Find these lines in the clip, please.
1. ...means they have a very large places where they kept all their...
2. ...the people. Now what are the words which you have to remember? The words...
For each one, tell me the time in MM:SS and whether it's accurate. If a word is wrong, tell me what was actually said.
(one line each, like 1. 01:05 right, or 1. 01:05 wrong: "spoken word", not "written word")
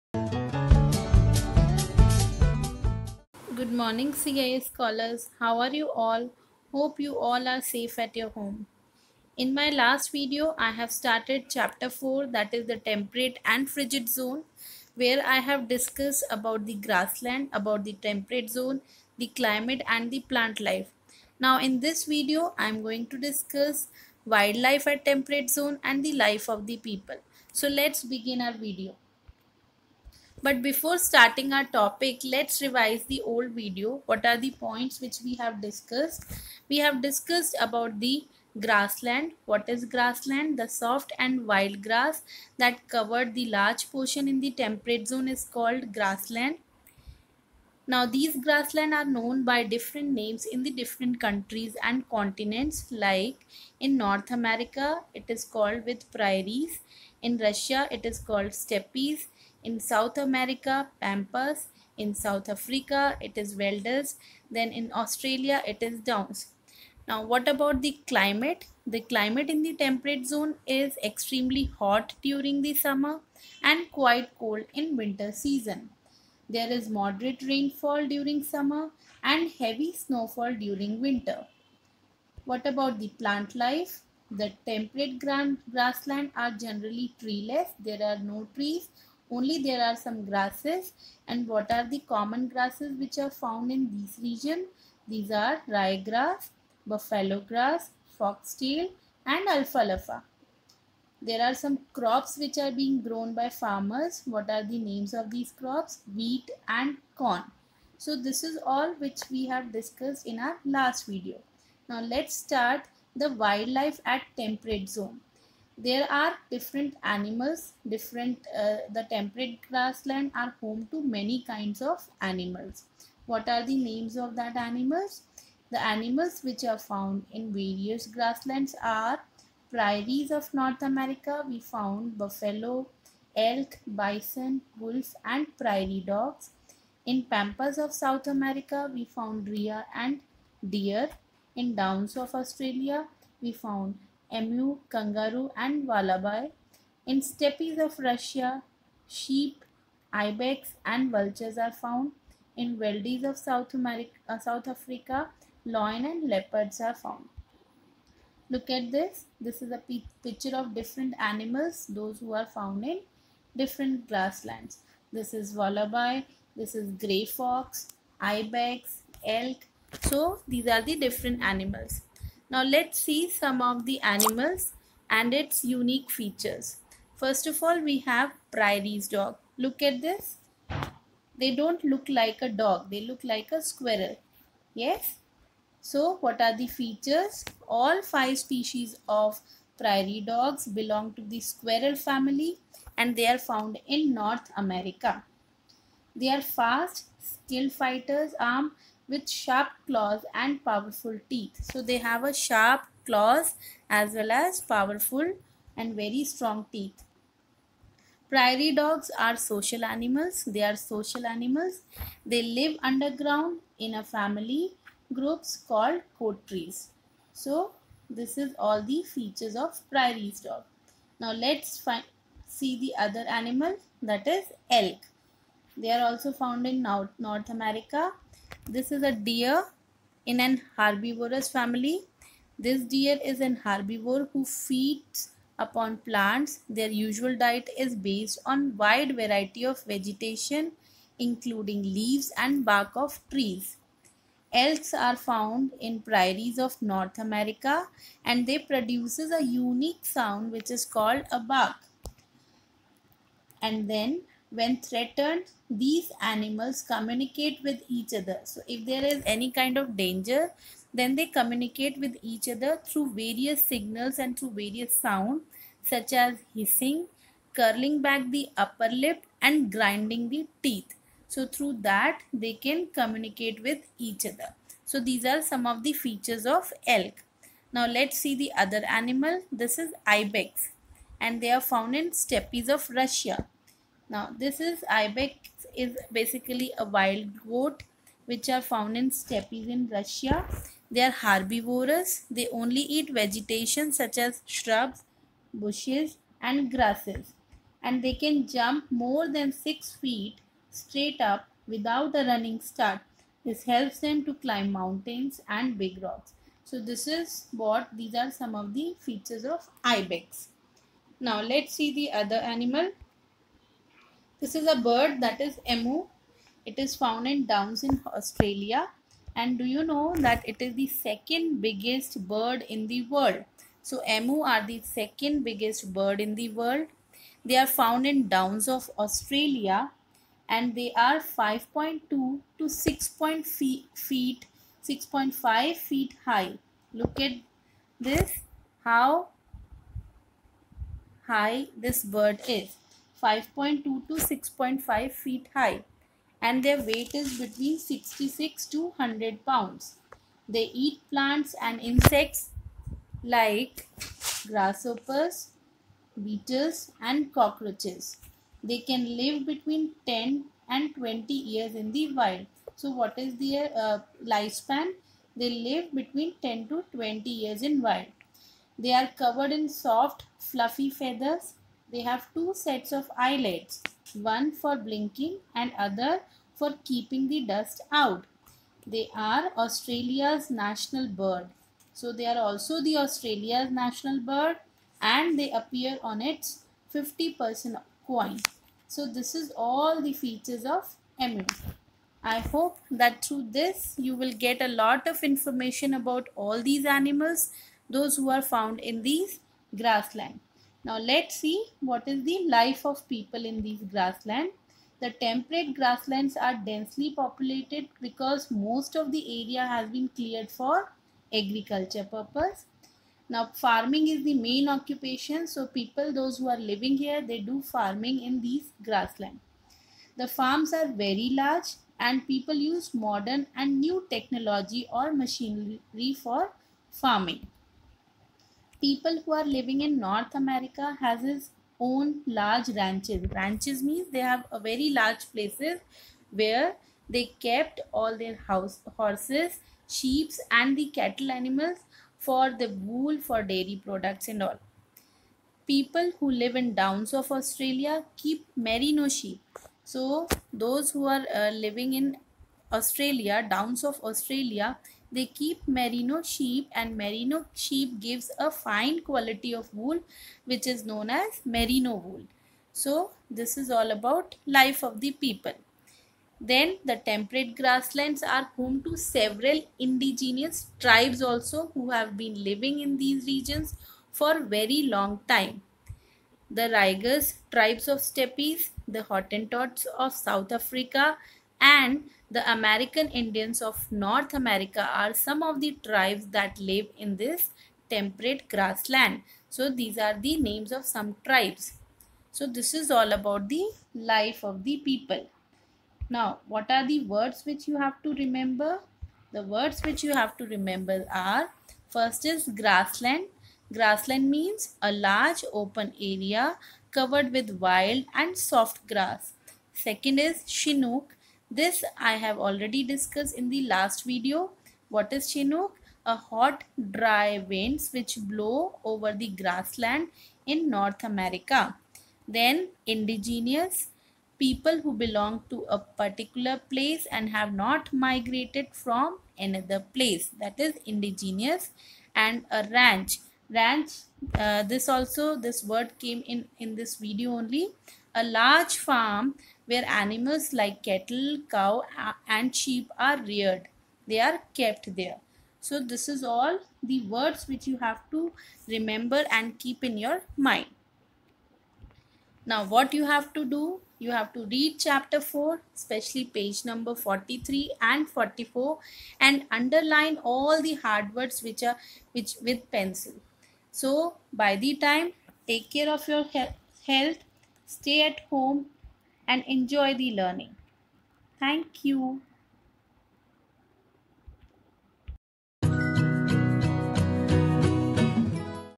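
1. 07:13 right
2. 08:14 right.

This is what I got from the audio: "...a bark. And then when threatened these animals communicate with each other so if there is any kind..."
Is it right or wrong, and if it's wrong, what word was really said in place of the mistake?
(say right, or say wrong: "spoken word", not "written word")
right.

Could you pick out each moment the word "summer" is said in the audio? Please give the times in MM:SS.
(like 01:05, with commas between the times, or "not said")
01:12, 01:18.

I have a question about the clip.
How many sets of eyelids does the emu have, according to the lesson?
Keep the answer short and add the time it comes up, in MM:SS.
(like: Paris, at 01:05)
2, at 06:12.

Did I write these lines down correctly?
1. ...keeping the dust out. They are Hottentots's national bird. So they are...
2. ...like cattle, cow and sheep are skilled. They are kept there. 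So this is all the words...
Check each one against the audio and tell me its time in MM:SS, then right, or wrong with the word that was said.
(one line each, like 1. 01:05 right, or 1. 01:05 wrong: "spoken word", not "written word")
1. 06:16 wrong: "Australia", not "Hottentots"
2. 09:00 wrong: "reared", not "skilled".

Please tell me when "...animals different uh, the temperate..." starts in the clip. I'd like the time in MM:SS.
01:57.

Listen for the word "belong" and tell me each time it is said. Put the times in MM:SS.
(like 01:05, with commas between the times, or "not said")
03:10, 08:44.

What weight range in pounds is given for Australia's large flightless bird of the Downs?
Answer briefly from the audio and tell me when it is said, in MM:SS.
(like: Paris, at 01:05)
66 to 100 pounds, at 05:47.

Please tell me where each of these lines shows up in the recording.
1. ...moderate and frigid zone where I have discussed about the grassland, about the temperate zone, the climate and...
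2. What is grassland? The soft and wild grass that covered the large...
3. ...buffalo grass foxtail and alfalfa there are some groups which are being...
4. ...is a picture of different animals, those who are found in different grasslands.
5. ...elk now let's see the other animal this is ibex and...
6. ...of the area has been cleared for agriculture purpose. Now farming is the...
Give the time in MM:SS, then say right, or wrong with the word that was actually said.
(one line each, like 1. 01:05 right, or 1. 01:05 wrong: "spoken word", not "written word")
1. 00:12 wrong: "temperate", not "moderate"
2. 00:39 right
3. 01:36 wrong: "crops", not "groups"
4. 02:39 right
5. 04:36 right
6. 06:48 right.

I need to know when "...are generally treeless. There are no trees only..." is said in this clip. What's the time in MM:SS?
01:26.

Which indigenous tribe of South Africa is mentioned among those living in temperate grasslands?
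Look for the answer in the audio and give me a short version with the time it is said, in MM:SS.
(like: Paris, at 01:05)
Hottentots, at 07:59.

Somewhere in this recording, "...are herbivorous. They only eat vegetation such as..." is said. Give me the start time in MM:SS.
04:51.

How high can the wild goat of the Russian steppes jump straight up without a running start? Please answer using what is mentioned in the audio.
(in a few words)
more than 6 feet.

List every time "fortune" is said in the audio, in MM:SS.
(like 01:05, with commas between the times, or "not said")
not said.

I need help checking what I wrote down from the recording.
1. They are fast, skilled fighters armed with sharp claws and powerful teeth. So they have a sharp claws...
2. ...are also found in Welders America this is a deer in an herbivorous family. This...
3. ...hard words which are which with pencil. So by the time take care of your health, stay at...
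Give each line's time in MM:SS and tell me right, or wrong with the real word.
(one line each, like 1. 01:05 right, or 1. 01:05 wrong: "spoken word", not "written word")
1. 03:16 right
2. 03:45 wrong: "North", not "Welders"
3. 09:20 right.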